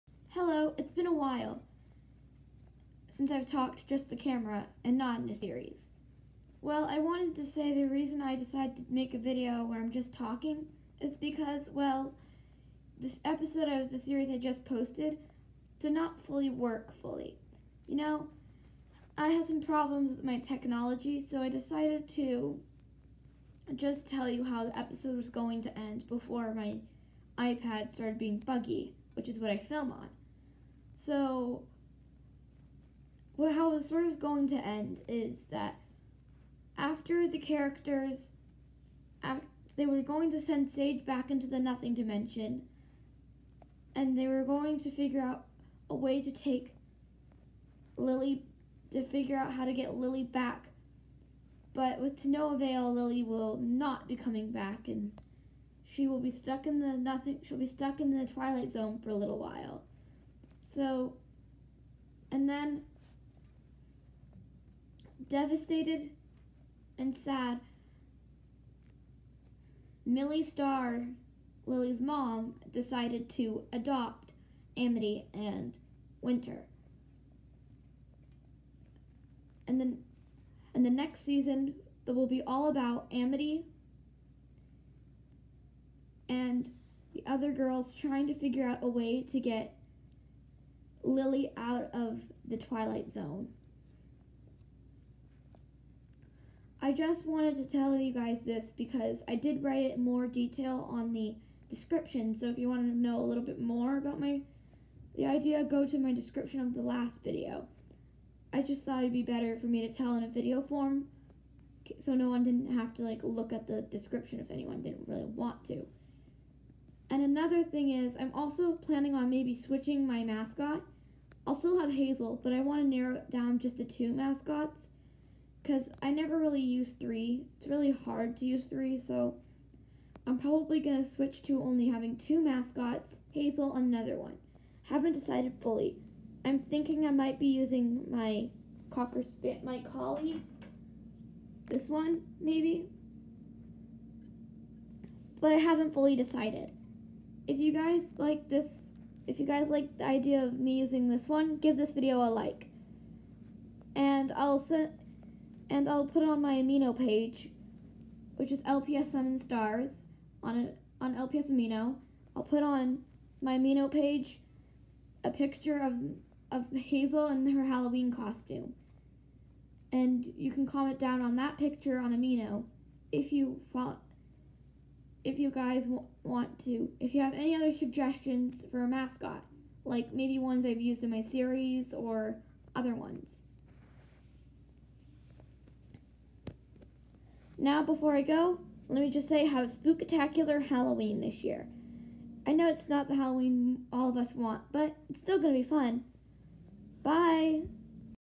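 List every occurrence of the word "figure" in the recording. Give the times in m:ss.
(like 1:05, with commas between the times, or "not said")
0:44, 0:49, 1:28.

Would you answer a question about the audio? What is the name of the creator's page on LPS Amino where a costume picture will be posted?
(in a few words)
LPS Sun and Stars.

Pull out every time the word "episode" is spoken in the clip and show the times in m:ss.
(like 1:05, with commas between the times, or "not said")
0:13, 0:24.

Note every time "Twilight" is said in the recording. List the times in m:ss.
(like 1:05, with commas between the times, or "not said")
0:58, 1:32.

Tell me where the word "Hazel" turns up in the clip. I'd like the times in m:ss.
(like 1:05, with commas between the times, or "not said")
2:01, 2:13, 2:46.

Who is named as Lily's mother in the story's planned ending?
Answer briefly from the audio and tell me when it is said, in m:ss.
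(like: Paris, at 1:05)
Millie Starr, at 1:10.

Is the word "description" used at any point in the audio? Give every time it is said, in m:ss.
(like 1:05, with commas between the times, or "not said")
1:41, 1:46, 1:53.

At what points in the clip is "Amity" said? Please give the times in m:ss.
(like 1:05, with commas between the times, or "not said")
1:14, 1:23.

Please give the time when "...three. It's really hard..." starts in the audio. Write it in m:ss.
2:06.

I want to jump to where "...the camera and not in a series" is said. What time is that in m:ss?
0:04.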